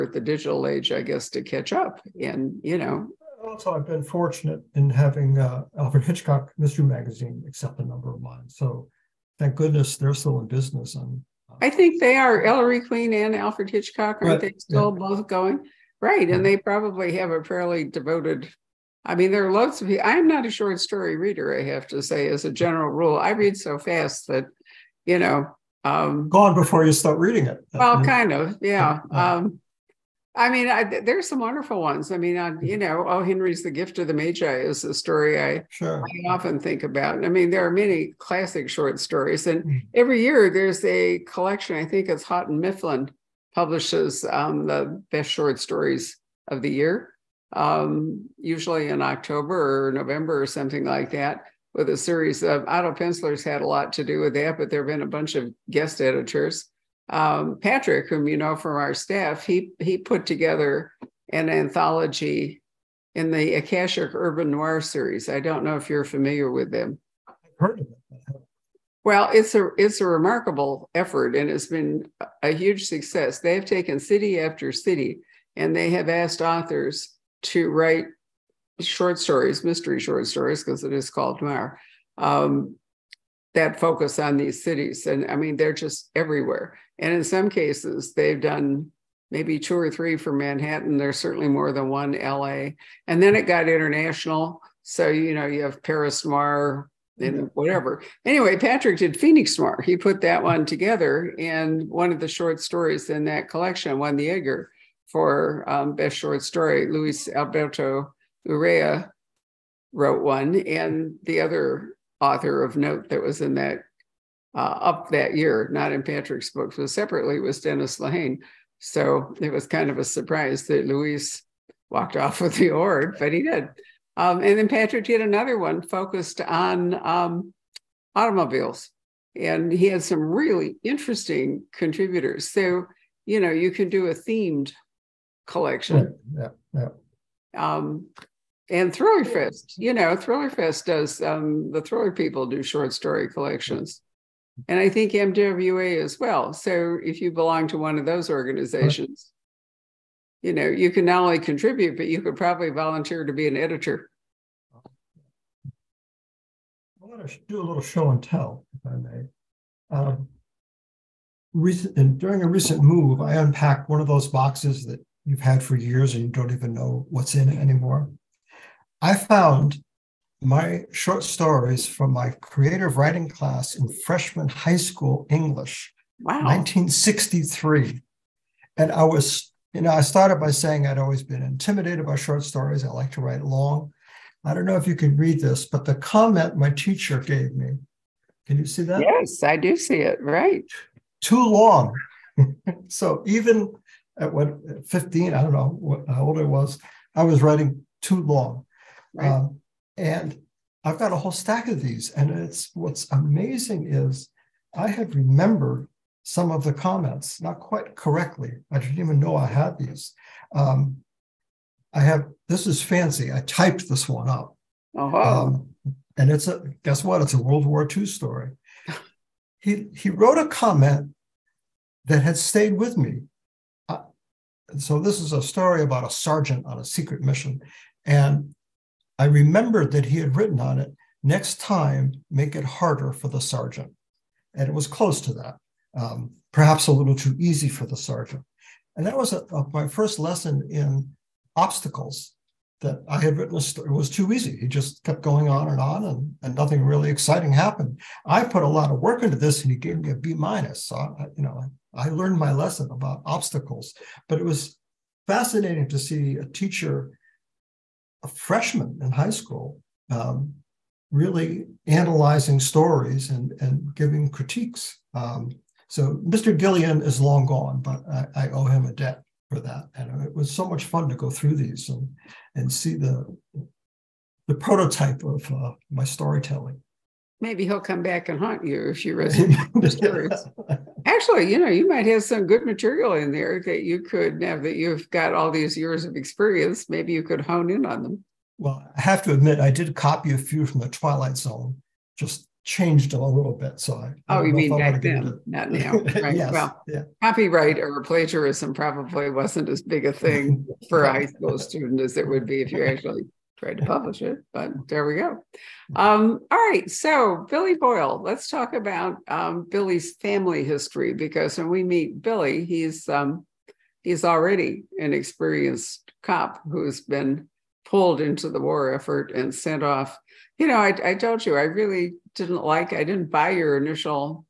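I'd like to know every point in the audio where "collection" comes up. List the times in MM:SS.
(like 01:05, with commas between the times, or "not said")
00:41, 01:43, 02:15, 02:23.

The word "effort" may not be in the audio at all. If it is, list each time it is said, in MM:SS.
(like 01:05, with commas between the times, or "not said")
01:10, 05:18.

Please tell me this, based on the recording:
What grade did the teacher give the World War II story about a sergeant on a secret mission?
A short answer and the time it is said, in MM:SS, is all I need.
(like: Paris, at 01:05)
B minus, at 04:10.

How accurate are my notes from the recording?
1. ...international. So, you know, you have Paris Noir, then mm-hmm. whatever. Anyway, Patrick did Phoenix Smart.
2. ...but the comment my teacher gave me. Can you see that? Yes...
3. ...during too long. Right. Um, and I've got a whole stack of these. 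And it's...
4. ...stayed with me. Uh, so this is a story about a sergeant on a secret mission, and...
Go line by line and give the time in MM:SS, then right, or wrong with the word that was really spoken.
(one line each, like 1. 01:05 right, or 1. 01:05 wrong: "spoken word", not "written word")
1. 01:33 right
2. 03:05 right
3. 03:17 wrong: "writing", not "during"
4. 03:42 right.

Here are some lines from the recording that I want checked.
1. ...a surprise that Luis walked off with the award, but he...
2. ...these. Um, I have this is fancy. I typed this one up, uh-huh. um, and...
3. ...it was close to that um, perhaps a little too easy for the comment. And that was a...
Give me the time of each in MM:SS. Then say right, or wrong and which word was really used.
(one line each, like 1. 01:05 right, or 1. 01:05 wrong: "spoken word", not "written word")
1. 01:59 right
2. 03:29 right
3. 03:54 wrong: "sergeant", not "comment".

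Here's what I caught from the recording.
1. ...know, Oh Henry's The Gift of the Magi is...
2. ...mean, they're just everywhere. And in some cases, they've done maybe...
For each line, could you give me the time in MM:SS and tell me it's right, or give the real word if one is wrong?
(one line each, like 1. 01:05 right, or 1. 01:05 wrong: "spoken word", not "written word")
1. 00:32 right
2. 01:25 right.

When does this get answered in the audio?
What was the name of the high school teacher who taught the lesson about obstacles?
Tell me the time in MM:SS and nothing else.
04:26.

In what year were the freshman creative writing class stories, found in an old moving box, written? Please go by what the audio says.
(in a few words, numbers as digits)
1963.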